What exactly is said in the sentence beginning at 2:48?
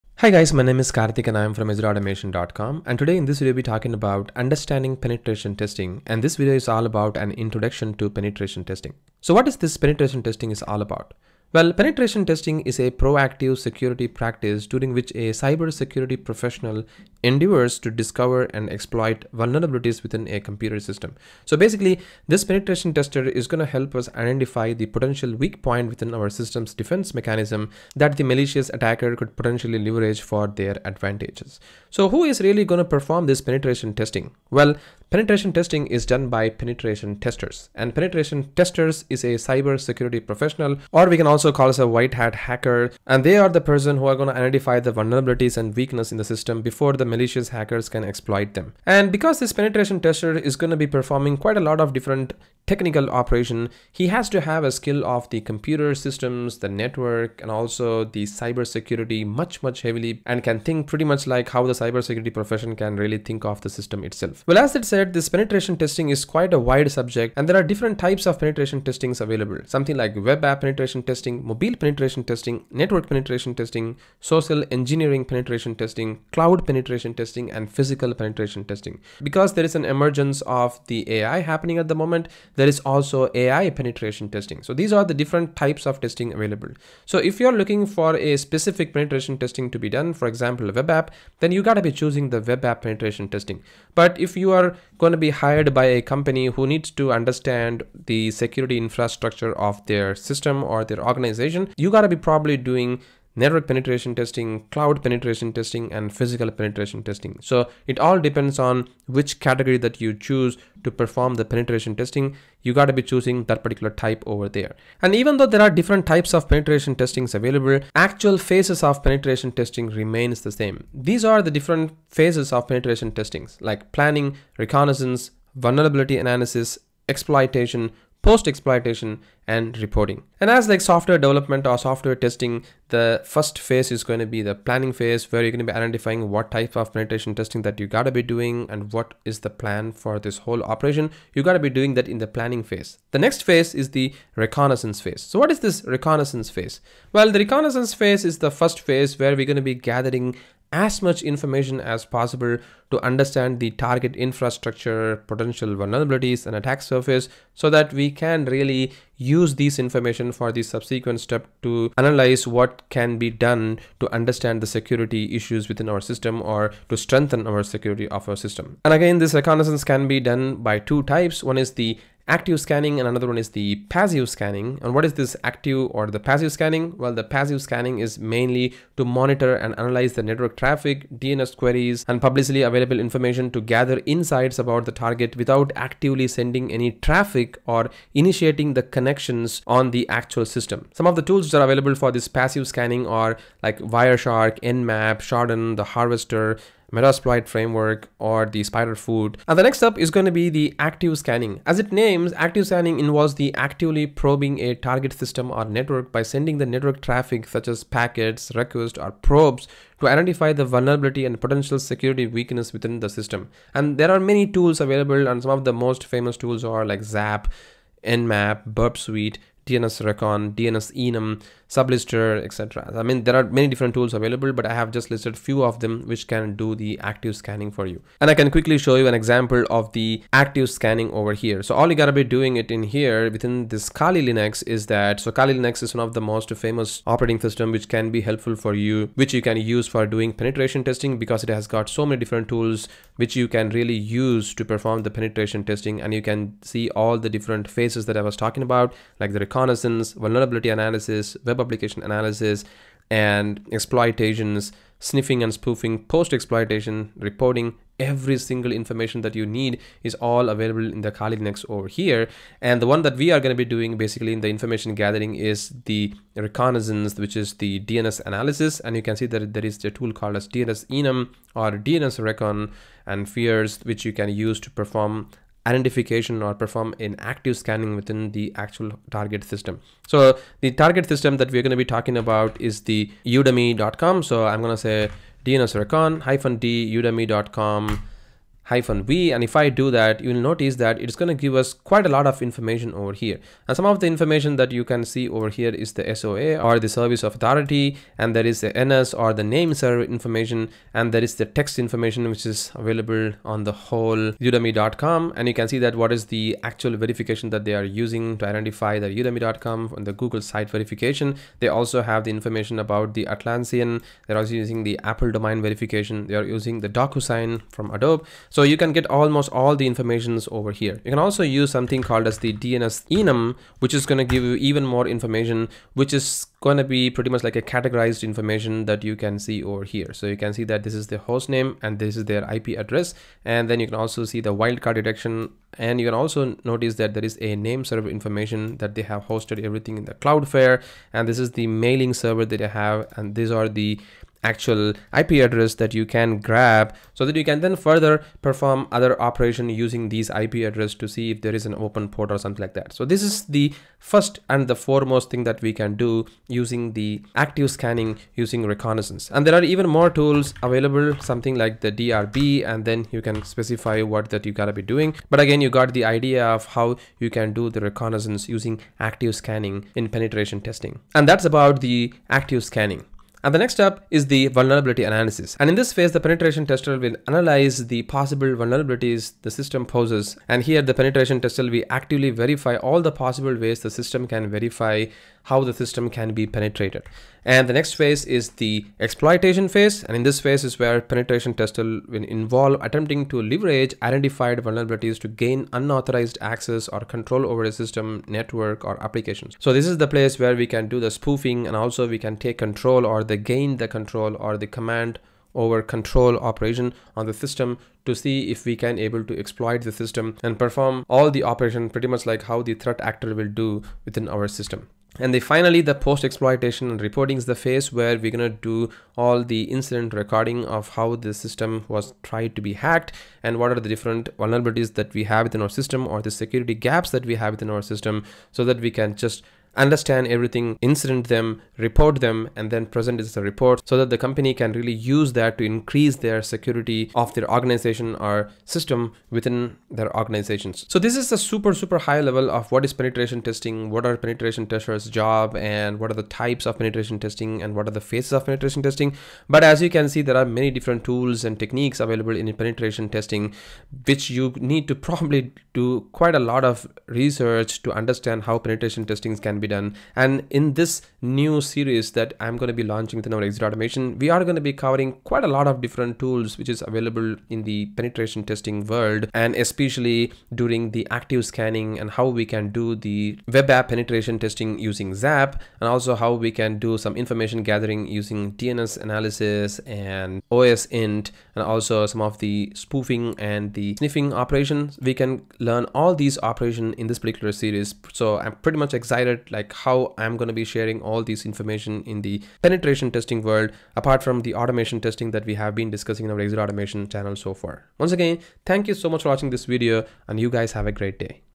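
And again, this reconnaissance can be done by two types.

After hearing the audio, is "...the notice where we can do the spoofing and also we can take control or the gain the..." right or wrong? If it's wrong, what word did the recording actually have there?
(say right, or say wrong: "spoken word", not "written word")
wrong: "place", not "notice".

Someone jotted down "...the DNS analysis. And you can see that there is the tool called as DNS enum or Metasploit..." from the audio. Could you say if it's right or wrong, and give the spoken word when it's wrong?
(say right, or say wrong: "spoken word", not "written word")
wrong: "DNS", not "Metasploit".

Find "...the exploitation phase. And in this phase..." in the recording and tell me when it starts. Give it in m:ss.
6:28.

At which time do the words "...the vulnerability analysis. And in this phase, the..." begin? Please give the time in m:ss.
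6:14.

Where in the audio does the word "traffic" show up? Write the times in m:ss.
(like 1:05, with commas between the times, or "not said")
3:00, 3:06, 3:27.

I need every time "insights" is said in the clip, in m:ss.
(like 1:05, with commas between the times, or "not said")
3:04.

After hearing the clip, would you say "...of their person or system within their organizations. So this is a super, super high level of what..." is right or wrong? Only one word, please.
wrong.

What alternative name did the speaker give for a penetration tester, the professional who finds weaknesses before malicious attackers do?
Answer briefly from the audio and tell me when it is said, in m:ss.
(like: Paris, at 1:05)
White hat hacker, at 0:41.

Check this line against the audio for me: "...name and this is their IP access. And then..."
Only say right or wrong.
wrong.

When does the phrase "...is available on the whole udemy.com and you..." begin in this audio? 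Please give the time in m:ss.
5:02.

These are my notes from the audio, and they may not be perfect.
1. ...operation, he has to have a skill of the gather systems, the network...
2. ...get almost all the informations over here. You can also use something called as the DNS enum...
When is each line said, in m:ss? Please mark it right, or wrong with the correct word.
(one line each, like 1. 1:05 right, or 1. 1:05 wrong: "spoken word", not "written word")
1. 0:53 wrong: "computer", not "gather"
2. 5:18 right.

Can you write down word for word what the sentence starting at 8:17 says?
Once again, thank you so much for watching this video and you guys have a great day.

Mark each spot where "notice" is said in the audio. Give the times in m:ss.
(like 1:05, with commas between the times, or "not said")
4:50, 5:36.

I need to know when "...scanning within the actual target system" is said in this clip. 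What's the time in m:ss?
4:37.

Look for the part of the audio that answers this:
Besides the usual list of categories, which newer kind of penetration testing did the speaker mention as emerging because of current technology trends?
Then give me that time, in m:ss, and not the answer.
1:23.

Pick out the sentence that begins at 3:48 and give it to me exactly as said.
And I can quickly show you an example of the active scanning over here.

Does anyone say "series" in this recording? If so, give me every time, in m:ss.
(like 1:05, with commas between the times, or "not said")
7:41, 8:07.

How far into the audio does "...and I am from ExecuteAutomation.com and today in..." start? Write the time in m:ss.
0:01.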